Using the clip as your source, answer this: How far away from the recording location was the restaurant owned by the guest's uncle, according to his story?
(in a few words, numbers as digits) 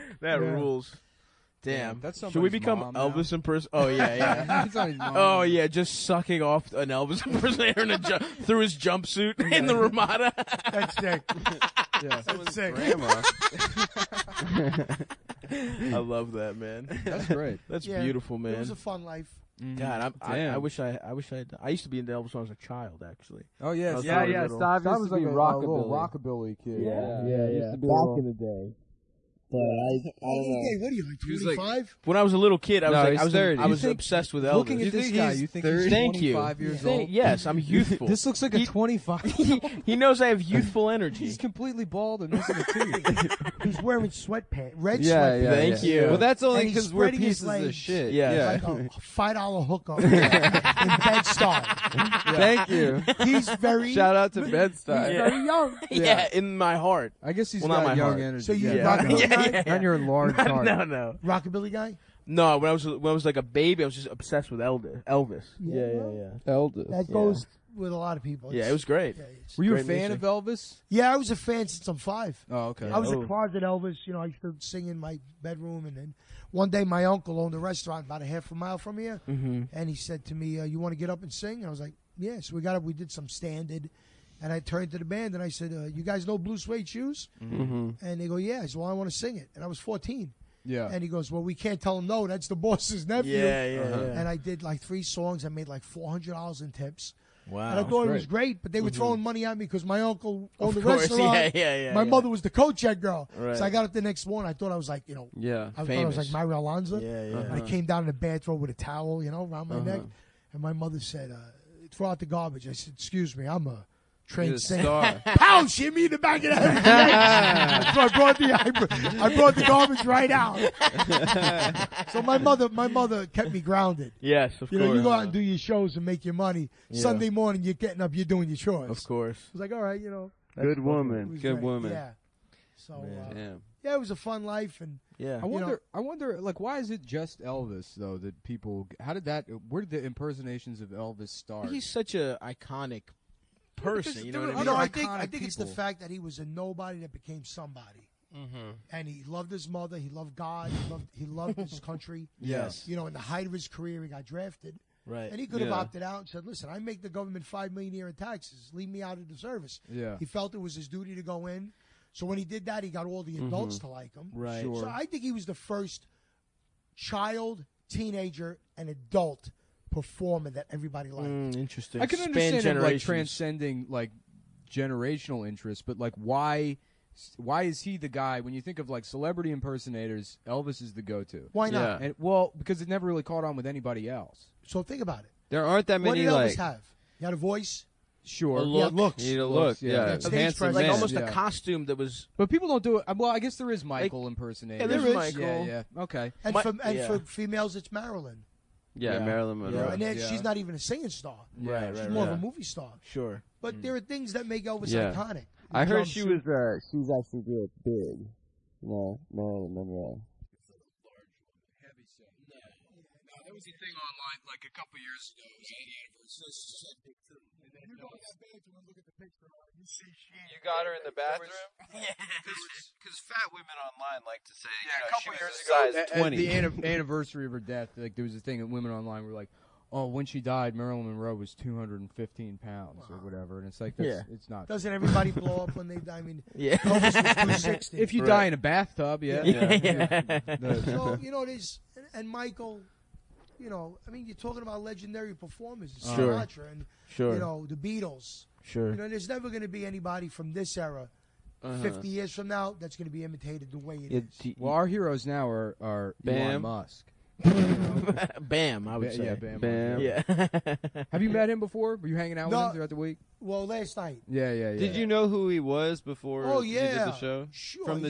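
half a mile.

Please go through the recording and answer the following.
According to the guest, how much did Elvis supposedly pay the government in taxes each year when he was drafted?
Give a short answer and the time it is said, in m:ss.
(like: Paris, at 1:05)
5 million, at 2:37.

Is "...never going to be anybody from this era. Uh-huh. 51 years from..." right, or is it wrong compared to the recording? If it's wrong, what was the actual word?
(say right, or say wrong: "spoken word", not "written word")
wrong: "50", not "51".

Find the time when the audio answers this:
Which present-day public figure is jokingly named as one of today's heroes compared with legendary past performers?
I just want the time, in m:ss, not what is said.
4:16.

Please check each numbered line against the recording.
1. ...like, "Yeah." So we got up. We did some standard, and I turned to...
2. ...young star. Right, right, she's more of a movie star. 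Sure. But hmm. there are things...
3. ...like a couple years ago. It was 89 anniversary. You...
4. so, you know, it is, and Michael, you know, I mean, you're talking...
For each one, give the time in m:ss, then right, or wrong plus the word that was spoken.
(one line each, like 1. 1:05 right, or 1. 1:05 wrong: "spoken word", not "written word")
1. 1:21 right
2. 3:20 wrong: "singing", not "young"
3. 3:34 wrong: "80", not "89"
4. 4:00 right.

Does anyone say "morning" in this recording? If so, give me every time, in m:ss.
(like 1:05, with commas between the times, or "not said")
1:44, 2:07.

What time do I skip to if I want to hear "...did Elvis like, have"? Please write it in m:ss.
3:06.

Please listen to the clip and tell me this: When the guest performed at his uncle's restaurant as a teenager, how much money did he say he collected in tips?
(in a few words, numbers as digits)
$400.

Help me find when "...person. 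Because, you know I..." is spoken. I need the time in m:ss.
2:23.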